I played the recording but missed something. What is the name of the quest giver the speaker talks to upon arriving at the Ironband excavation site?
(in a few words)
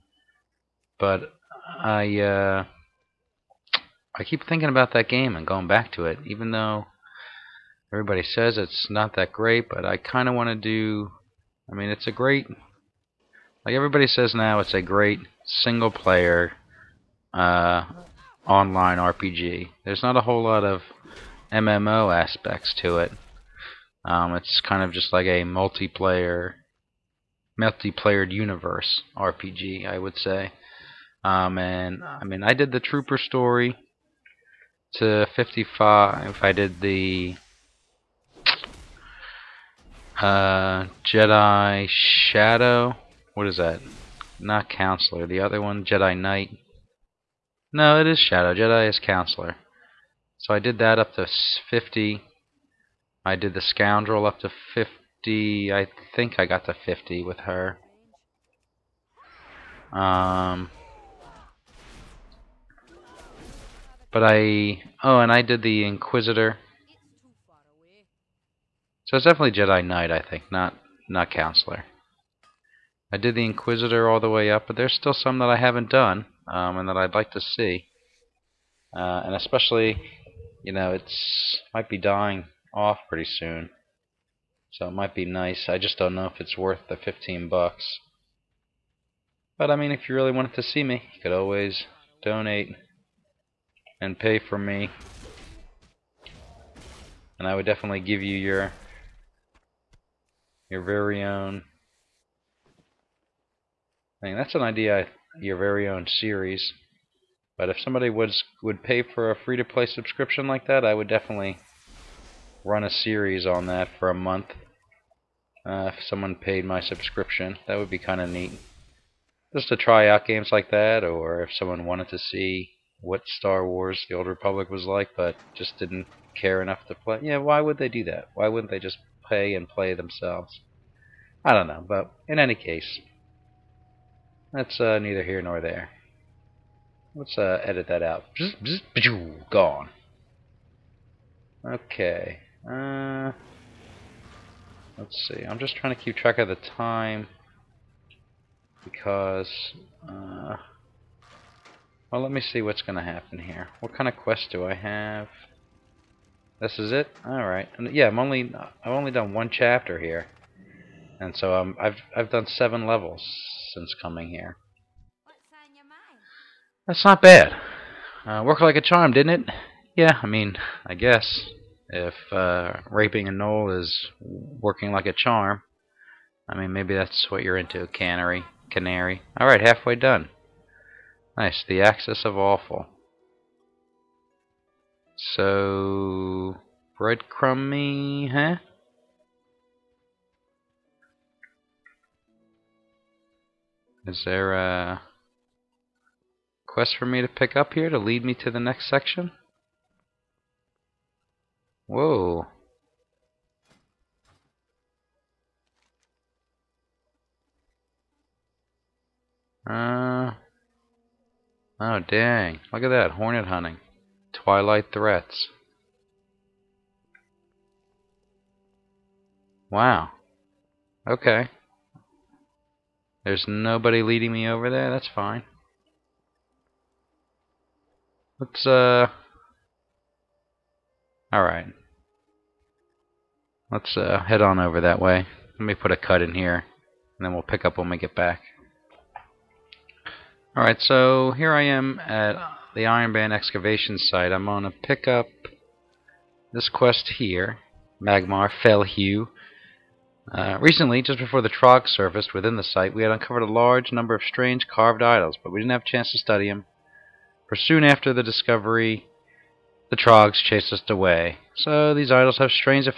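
Magmar Fellhew.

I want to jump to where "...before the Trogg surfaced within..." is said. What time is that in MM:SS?
04:11.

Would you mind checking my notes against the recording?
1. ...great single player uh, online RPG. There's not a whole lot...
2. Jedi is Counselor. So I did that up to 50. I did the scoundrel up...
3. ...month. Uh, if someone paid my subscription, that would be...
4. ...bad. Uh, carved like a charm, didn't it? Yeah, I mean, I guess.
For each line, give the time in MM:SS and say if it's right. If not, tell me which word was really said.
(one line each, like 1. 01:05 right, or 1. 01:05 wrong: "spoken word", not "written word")
1. 00:14 right
2. 00:48 right
3. 01:54 right
4. 02:47 wrong: "worked", not "carved".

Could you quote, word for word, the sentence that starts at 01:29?
But I mean, if you really wanted to see me, you could always donate and pay for me.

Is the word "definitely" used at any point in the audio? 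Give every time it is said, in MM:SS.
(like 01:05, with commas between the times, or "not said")
01:09, 01:37, 01:51.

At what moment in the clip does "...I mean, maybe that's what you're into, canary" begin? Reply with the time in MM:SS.
02:56.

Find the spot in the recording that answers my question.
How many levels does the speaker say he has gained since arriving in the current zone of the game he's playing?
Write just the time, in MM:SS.
02:42.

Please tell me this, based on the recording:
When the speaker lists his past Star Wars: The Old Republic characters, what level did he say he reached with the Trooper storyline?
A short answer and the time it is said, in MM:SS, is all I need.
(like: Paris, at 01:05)
55, at 00:35.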